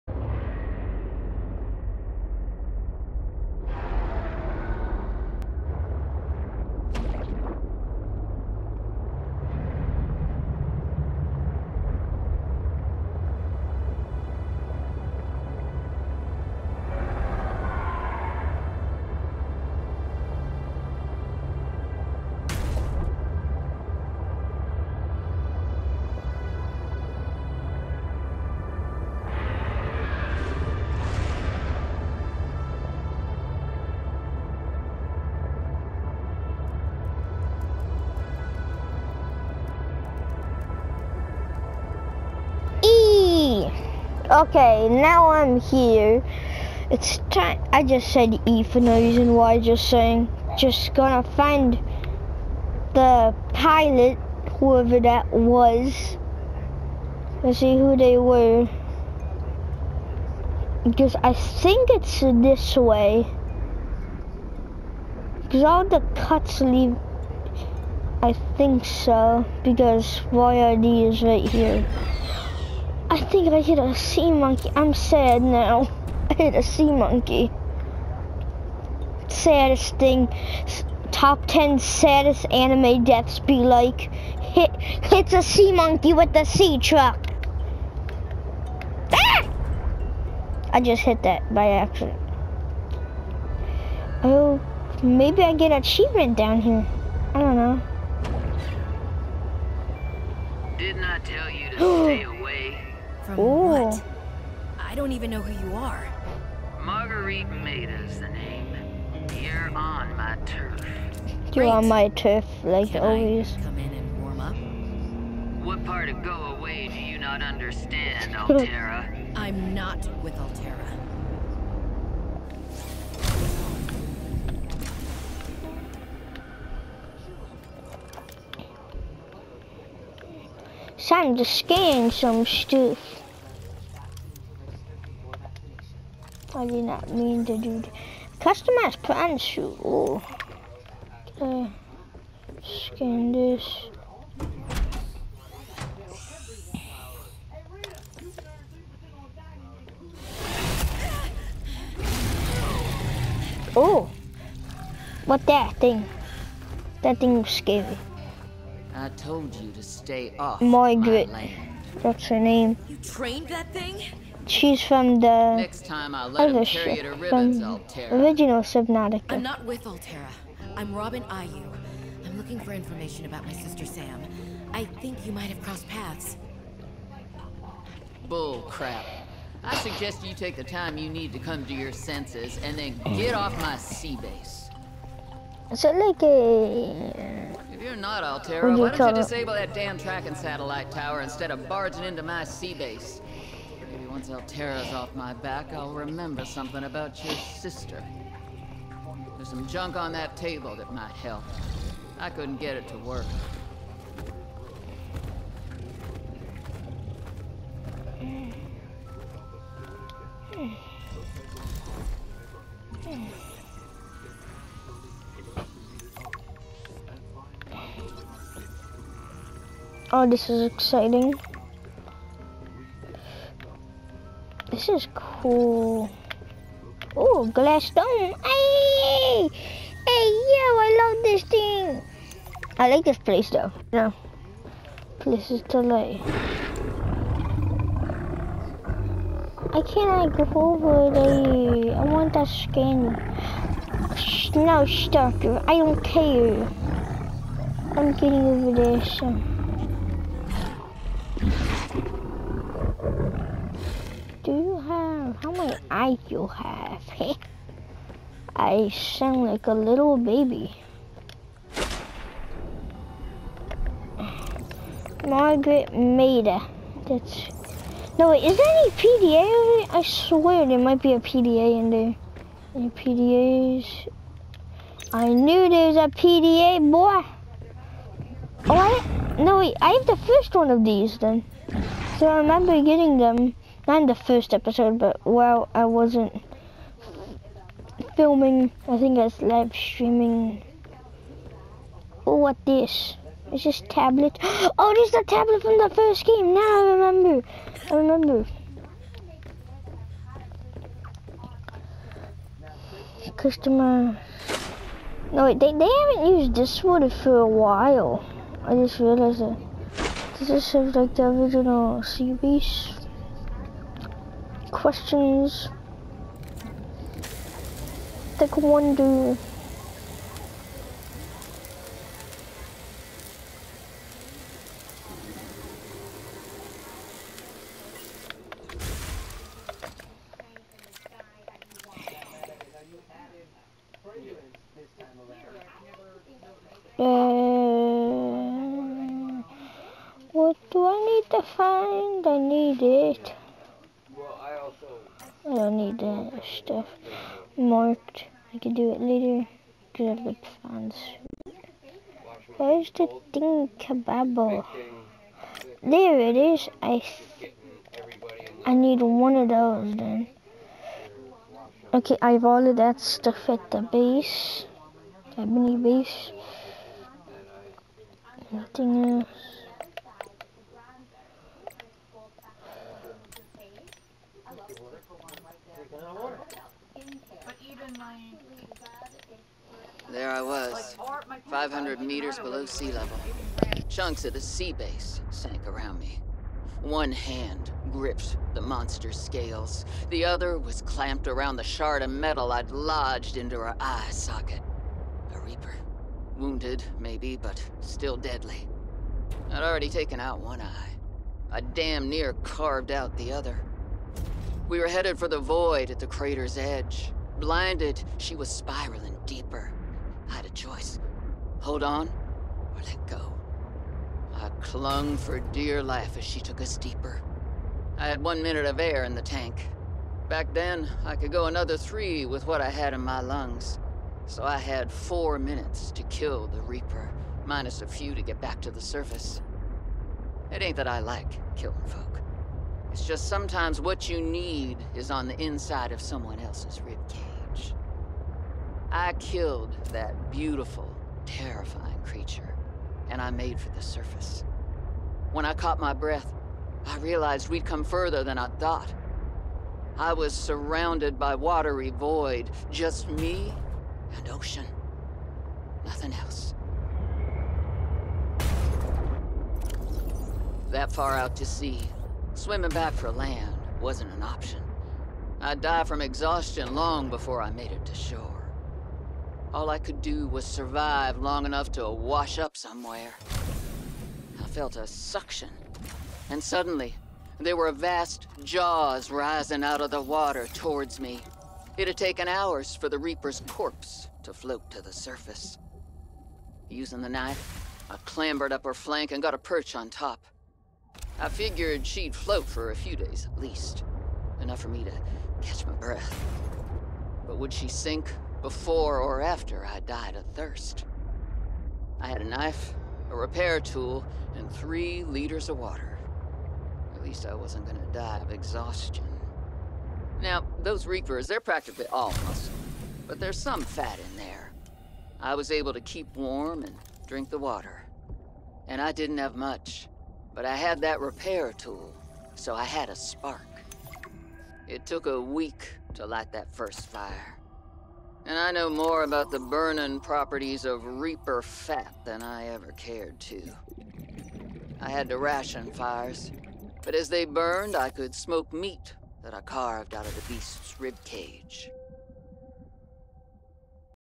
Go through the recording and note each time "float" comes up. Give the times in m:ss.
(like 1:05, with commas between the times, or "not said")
8:04, 8:12.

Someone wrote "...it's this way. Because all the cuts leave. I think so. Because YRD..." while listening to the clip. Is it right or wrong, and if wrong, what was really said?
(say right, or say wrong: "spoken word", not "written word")
right.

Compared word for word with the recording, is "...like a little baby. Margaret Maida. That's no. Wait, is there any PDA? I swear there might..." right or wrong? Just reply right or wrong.
right.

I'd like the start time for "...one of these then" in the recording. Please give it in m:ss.
4:40.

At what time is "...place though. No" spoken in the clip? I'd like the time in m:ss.
3:53.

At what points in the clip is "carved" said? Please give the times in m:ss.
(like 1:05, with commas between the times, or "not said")
6:42, 8:59.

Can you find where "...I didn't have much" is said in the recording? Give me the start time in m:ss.
8:38.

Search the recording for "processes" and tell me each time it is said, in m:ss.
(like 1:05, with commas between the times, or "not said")
not said.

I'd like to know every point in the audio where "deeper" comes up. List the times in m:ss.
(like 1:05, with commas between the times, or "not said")
6:49, 6:56.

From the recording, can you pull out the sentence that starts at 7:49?
All I could do was survive long enough to wash up somewhere.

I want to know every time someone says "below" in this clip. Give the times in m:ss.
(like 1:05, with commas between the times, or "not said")
6:22.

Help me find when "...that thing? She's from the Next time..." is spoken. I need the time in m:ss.
2:43.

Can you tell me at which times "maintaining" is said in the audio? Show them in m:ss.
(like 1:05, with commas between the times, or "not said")
not said.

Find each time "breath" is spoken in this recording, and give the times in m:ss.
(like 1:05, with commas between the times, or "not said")
7:25, 8:15.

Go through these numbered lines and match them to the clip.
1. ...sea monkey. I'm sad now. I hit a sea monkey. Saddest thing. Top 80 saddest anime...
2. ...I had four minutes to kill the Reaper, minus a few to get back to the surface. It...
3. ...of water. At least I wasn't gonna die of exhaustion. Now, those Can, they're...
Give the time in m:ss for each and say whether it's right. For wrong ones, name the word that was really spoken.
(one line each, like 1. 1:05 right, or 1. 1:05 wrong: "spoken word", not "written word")
1. 1:13 wrong: "10", not "80"
2. 7:04 right
3. 8:25 wrong: "Reapers", not "Can".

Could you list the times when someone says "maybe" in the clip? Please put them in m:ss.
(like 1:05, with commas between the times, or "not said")
1:35, 6:36.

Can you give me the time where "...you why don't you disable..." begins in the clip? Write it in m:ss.
3:08.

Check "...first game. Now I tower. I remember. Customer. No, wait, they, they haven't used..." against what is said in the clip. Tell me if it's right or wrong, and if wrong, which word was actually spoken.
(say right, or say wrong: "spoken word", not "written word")
wrong: "remember", not "tower".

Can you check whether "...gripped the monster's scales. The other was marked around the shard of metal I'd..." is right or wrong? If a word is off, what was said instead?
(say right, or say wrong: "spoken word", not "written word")
wrong: "clamped", not "marked".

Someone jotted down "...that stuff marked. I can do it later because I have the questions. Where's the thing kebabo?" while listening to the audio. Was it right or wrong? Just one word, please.
wrong.